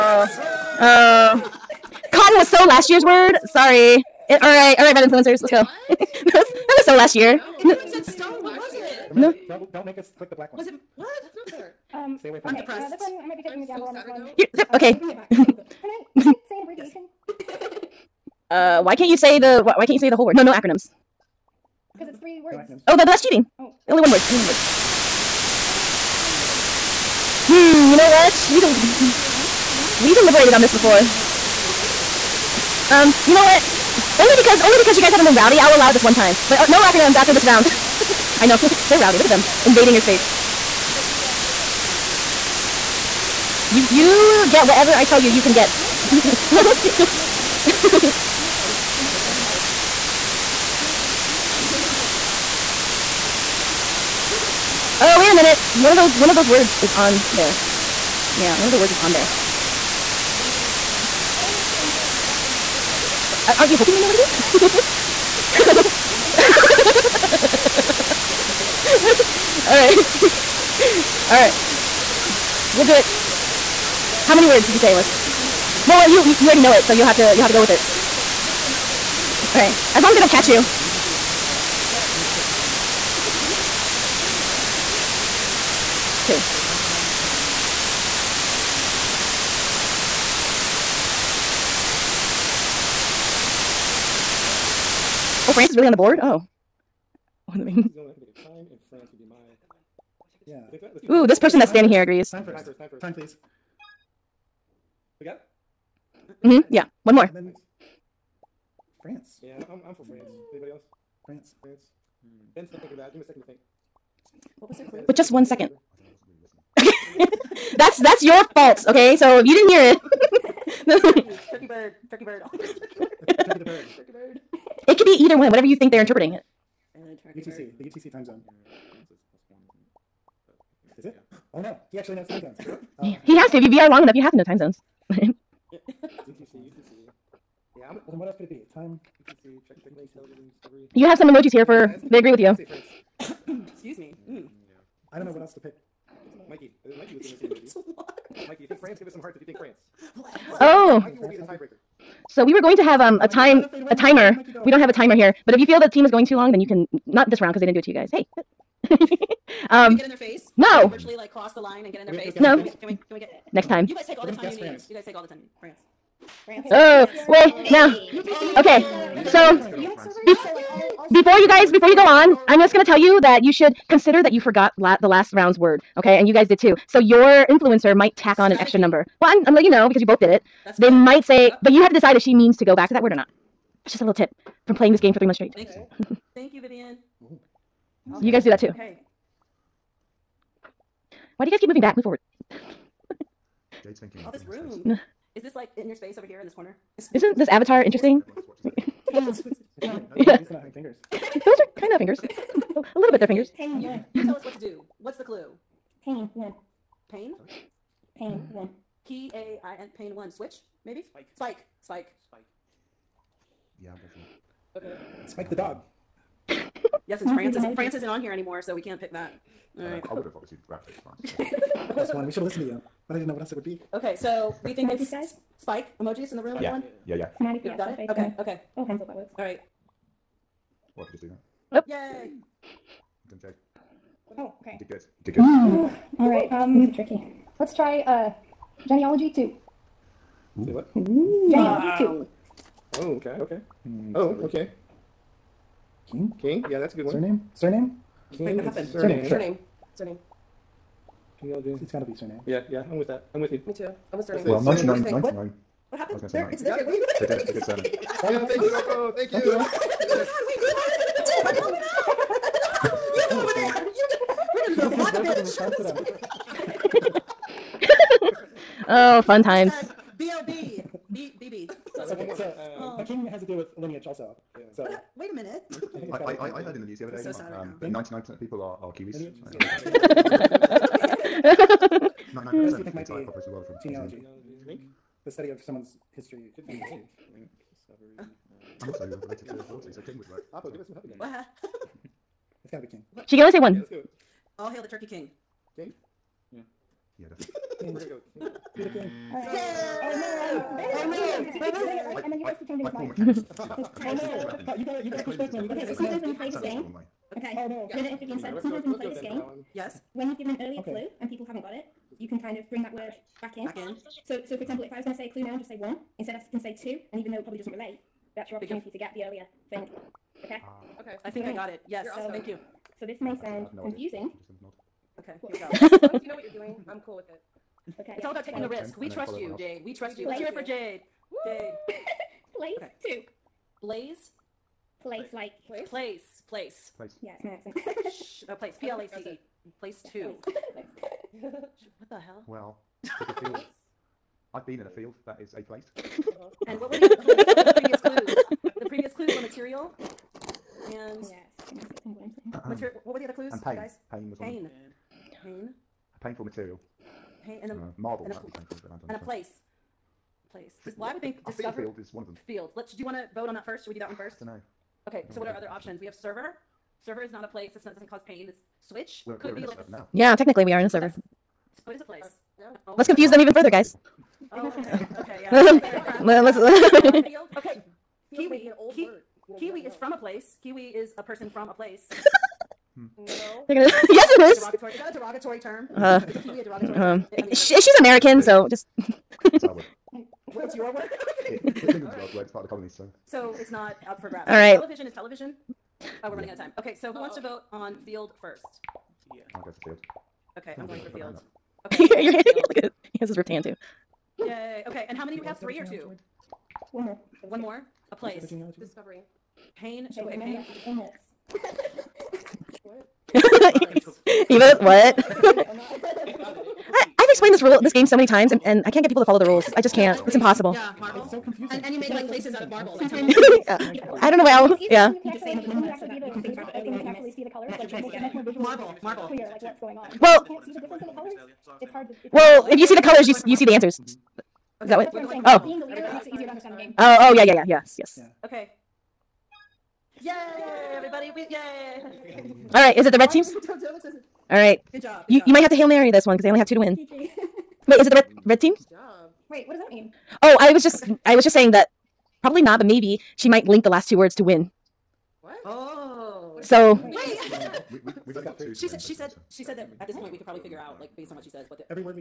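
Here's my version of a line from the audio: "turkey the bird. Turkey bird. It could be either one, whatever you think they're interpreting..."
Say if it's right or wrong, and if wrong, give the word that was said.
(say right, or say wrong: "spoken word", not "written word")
right.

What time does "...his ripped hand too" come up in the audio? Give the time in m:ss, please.
6:43.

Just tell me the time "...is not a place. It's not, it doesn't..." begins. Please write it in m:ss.
6:07.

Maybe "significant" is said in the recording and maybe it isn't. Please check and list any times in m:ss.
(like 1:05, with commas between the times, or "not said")
not said.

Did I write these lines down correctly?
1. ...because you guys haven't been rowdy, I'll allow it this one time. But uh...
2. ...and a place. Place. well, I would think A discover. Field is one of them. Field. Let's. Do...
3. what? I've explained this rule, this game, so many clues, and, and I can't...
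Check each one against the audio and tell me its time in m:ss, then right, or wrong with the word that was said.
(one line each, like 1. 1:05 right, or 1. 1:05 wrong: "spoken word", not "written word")
1. 0:34 right
2. 5:59 right
3. 6:54 wrong: "times", not "clues".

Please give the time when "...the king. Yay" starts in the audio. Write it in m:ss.
4:58.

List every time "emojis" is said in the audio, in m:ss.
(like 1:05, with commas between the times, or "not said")
2:21, 2:27, 3:46.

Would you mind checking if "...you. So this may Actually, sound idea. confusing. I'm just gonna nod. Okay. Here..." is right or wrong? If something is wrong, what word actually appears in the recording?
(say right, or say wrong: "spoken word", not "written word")
right.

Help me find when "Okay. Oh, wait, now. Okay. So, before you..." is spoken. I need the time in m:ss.
2:46.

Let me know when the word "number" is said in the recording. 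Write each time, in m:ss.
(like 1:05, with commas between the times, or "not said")
2:58, 7:05.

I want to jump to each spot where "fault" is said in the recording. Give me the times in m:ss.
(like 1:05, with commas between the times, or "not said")
1:58.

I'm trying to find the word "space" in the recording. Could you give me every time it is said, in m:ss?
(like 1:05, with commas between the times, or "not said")
0:39, 3:15.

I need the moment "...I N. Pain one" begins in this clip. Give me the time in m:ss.
3:29.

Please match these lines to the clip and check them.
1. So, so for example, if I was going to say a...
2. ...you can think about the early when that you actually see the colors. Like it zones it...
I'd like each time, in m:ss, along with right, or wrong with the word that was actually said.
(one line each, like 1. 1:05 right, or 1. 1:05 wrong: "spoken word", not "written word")
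1. 5:14 right
2. 7:06 wrong: "makes", not "zones".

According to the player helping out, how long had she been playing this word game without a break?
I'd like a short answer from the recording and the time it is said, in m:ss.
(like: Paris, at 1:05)
Three months, at 3:05.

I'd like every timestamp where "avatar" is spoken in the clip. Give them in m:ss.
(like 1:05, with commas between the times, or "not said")
3:17.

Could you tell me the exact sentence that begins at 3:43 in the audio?
Okay, so we think it's guys?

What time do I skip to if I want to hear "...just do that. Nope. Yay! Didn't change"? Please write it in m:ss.
3:51.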